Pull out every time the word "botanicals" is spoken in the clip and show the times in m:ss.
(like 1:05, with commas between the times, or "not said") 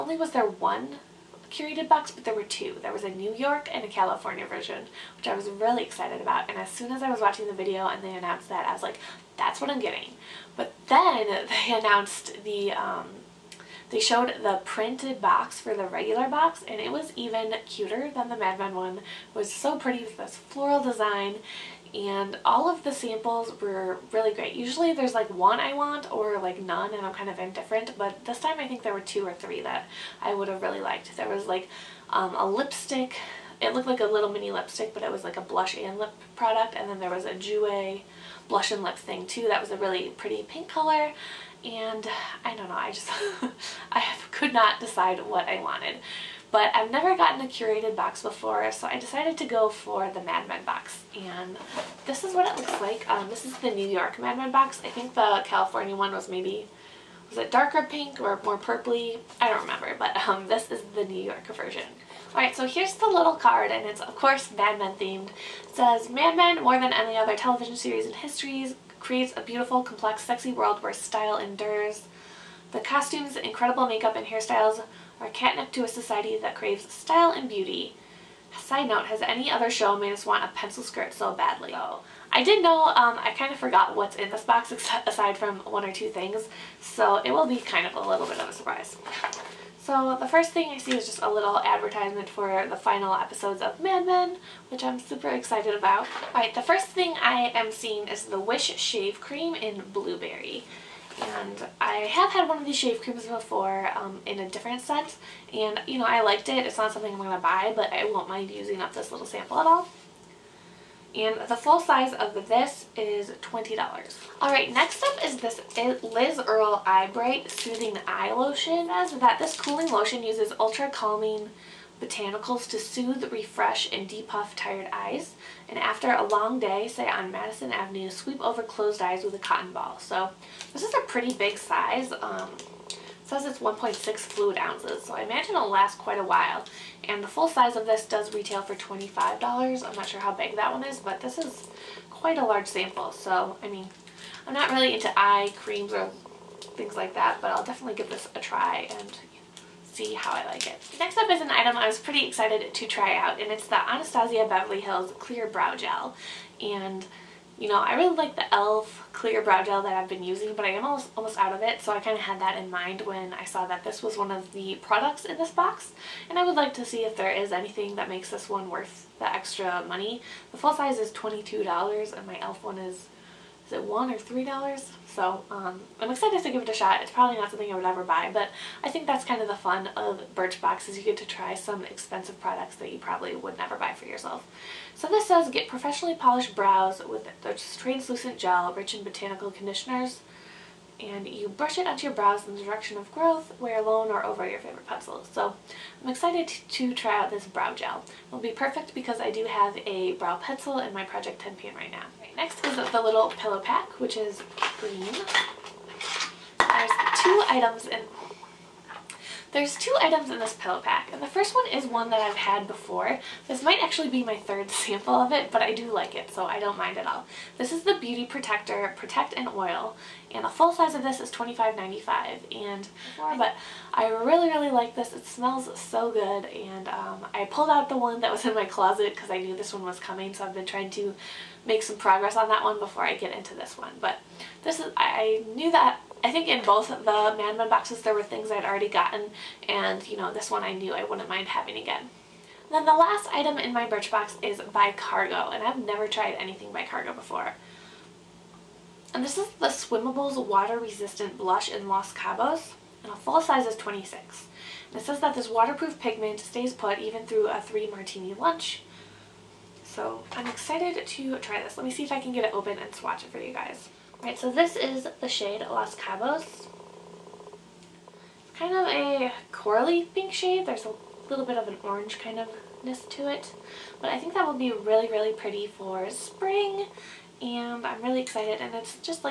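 2:02, 3:09.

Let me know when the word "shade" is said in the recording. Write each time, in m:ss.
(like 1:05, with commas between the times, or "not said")
4:25, 4:30.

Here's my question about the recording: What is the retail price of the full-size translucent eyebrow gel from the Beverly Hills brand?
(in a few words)
$22.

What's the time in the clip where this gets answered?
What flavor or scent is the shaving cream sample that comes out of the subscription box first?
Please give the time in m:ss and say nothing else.
1:39.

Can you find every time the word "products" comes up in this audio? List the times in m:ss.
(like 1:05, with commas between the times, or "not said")
0:36, 2:44, 3:02.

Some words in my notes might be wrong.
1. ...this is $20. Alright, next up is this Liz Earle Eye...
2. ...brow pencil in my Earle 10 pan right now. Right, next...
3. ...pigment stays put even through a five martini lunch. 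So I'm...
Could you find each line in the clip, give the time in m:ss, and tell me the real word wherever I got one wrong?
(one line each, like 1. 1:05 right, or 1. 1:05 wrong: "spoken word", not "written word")
1. 1:52 right
2. 3:20 wrong: "Project", not "Earle"
3. 4:15 wrong: "three", not "five".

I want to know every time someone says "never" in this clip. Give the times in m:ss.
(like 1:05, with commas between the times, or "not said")
0:46, 3:03, 4:05.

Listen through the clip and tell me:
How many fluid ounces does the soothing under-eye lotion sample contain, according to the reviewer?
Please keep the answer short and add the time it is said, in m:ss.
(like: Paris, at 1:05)
1.6, at 2:13.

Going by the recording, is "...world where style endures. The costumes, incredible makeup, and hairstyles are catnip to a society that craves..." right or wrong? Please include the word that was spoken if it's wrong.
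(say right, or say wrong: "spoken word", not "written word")
right.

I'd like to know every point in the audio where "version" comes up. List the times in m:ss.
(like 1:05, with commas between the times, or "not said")
0:04, 1:01.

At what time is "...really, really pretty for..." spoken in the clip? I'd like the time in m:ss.
4:34.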